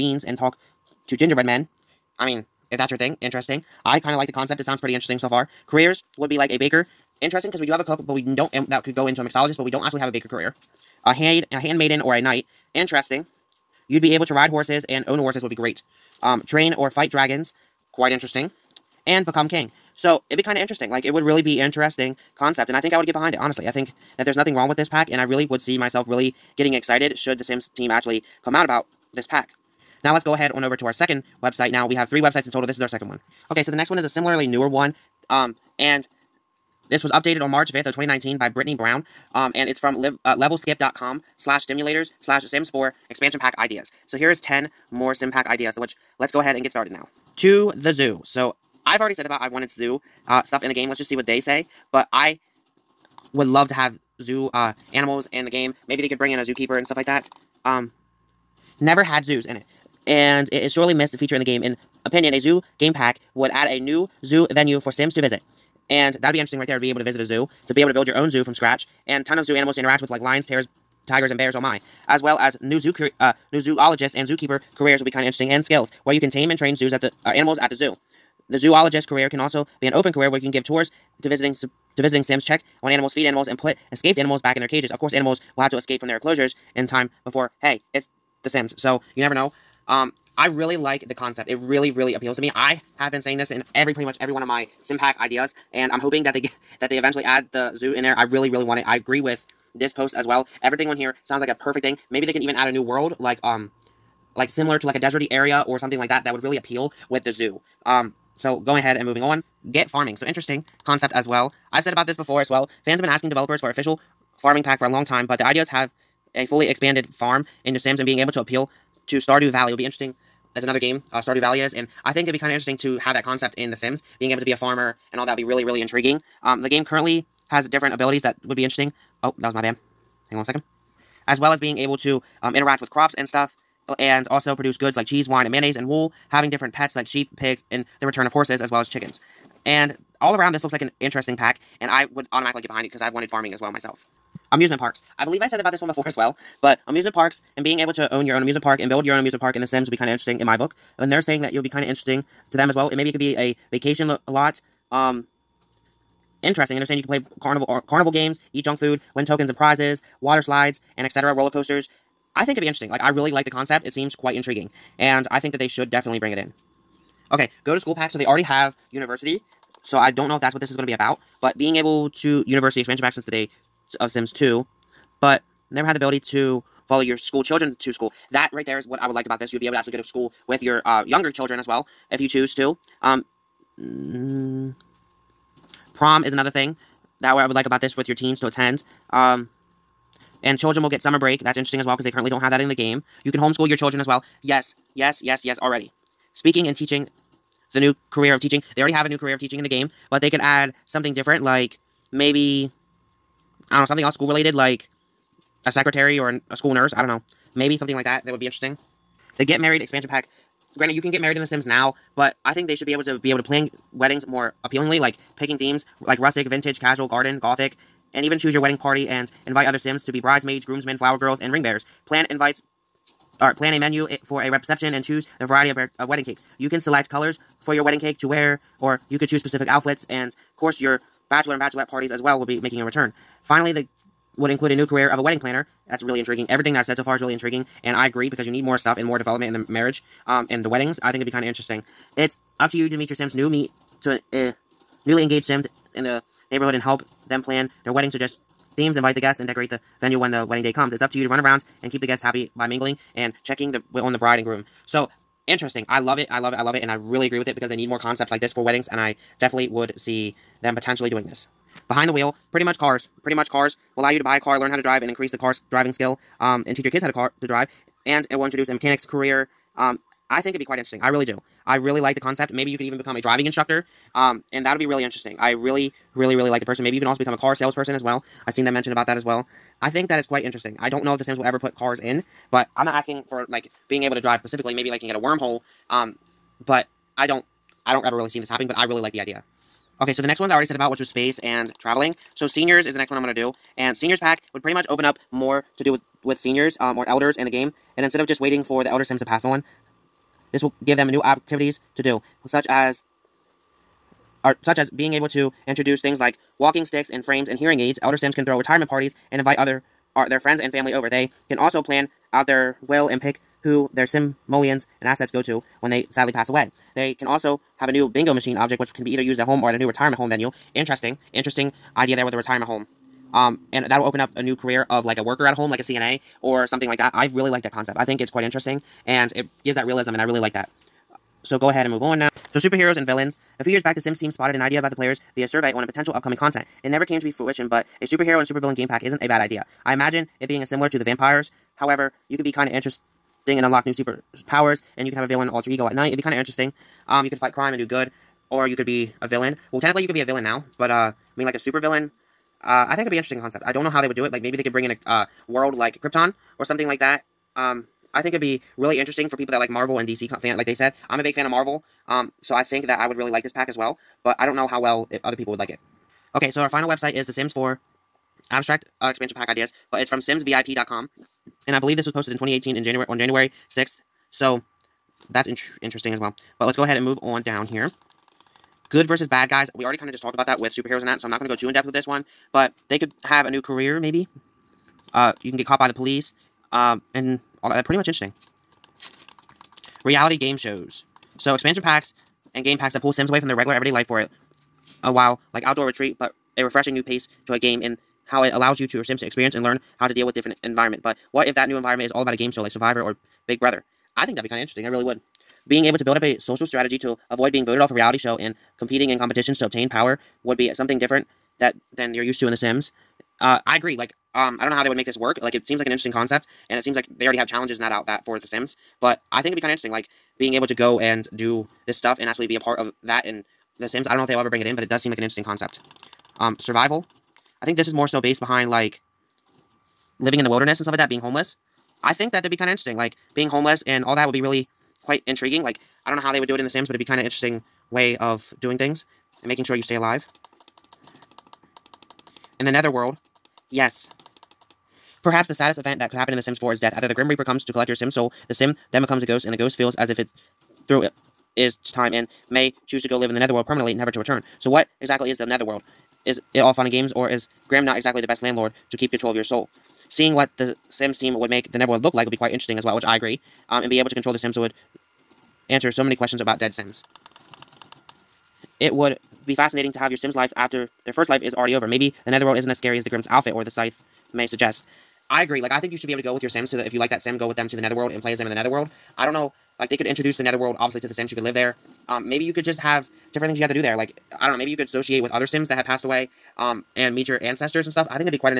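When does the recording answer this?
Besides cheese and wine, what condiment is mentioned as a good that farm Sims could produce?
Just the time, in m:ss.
2:15.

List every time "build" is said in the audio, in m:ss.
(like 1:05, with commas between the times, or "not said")
1:07, 2:28, 6:46.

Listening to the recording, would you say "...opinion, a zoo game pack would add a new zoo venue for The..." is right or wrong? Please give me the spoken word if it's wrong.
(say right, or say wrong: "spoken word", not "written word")
wrong: "Sims", not "The".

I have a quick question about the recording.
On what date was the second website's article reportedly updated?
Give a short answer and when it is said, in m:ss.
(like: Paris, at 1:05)
March 5th, 2019, at 0:37.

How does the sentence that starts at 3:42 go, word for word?
Plan invites or plan a menu for a reception and choose the variety of, of wedding cakes.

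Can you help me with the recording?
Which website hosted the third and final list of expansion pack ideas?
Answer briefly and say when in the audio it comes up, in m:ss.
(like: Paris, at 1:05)
simsvip.com, at 6:10.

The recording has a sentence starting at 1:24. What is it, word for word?
Of course, animals will have to escape from their enclosures in time before, hey, it's The Sims.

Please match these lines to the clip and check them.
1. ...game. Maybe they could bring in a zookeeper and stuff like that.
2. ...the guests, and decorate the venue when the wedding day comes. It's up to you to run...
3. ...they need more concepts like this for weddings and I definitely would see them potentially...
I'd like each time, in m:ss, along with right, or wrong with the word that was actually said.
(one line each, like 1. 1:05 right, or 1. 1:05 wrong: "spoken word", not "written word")
1. 0:55 right
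2. 4:09 right
3. 4:17 right.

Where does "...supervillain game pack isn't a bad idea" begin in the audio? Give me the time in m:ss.
5:38.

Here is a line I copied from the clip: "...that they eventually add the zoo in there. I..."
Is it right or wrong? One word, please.
right.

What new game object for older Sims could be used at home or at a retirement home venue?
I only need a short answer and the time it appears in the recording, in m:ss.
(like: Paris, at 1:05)
Bingo machine, at 5:18.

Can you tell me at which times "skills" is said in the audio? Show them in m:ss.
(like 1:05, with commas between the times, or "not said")
1:15, 4:25.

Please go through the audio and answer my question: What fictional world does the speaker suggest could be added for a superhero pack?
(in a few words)
Krypton.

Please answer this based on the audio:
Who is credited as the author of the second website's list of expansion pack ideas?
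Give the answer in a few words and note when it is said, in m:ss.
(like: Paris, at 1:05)
Brittany Brown, at 0:38.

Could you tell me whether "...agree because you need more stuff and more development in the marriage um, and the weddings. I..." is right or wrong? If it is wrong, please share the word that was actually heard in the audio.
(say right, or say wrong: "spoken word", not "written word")
right.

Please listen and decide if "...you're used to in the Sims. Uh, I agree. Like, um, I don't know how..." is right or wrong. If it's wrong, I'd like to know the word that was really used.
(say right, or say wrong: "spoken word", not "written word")
right.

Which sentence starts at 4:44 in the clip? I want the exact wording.
Maybe like you can get a wormhole, um, but I don't.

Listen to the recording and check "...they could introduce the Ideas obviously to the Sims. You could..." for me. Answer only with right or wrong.
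wrong.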